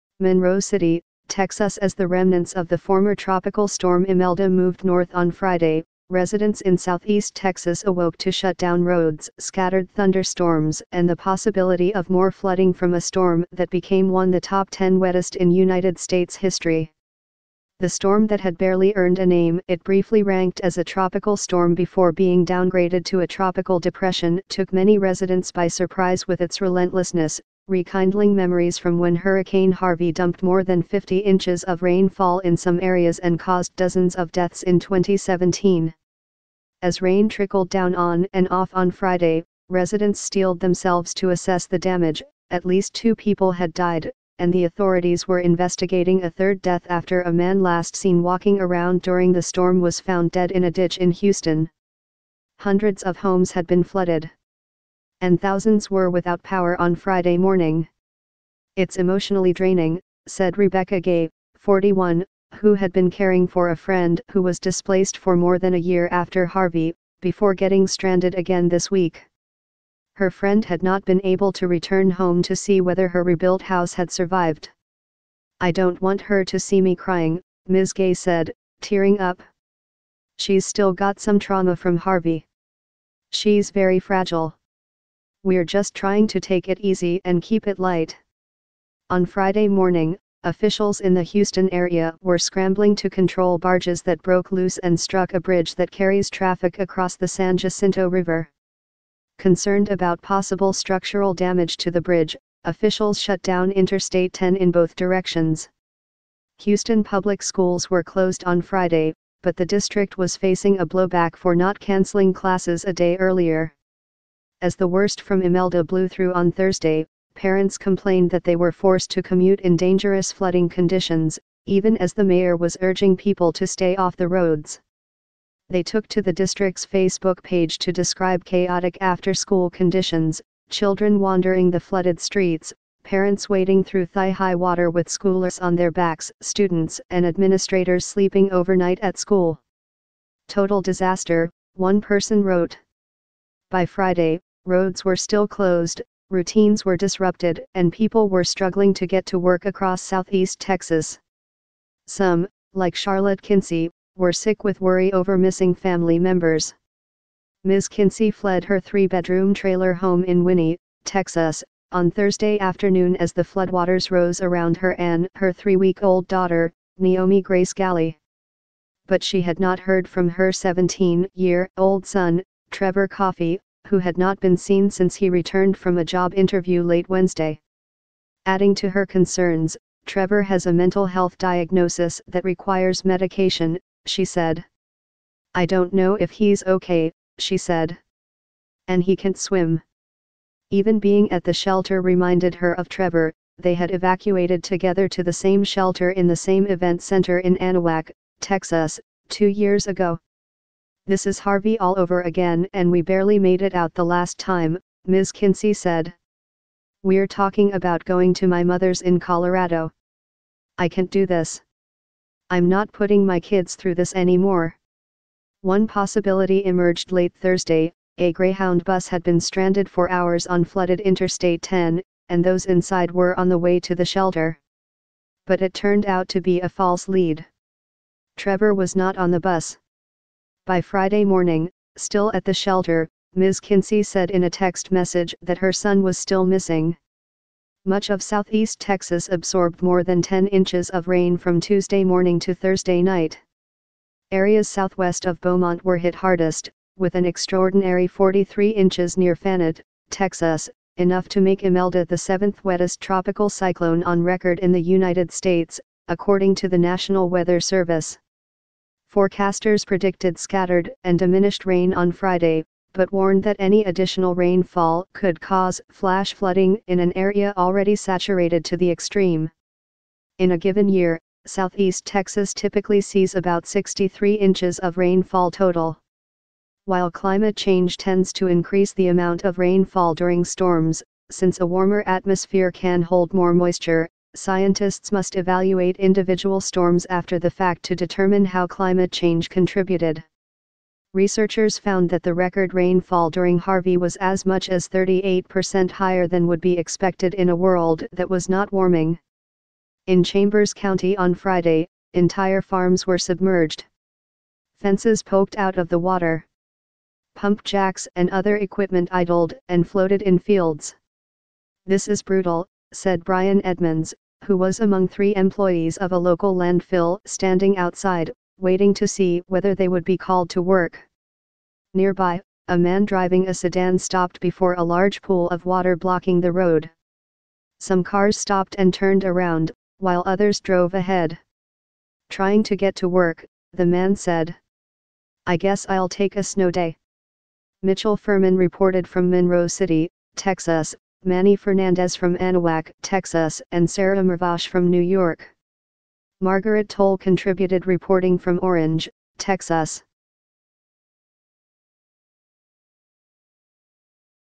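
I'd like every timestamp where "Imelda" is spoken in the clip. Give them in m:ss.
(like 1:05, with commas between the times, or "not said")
0:04, 1:55, 4:11.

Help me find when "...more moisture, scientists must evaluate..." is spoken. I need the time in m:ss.
4:43.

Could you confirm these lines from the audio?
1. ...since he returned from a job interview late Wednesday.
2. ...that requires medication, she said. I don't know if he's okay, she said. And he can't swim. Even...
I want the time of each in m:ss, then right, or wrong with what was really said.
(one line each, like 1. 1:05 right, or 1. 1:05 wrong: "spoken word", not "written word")
1. 2:54 right
2. 3:02 right.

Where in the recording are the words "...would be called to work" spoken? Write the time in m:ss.
5:19.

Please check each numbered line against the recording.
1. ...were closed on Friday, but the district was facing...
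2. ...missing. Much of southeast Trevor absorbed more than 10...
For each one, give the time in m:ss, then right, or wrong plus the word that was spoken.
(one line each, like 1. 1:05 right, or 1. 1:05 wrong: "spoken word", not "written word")
1. 1:47 right
2. 3:56 wrong: "Texas", not "Trevor".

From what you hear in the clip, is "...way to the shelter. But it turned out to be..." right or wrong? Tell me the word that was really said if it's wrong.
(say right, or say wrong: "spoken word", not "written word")
right.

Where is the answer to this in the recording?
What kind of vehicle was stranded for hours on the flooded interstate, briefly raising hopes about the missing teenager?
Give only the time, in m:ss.
3:38.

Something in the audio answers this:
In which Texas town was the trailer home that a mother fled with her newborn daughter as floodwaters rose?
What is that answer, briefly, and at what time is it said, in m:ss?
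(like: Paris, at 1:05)
Winnie, at 2:40.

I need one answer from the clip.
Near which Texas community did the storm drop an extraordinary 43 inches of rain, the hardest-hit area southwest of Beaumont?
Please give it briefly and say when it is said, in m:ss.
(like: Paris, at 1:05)
Fannett, at 4:09.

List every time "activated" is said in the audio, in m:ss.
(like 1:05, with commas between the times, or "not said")
not said.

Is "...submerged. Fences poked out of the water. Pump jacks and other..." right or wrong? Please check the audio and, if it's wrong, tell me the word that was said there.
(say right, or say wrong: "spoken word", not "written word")
right.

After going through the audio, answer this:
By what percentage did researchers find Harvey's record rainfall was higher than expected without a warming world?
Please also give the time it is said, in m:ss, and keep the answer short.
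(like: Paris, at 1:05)
38%, at 4:54.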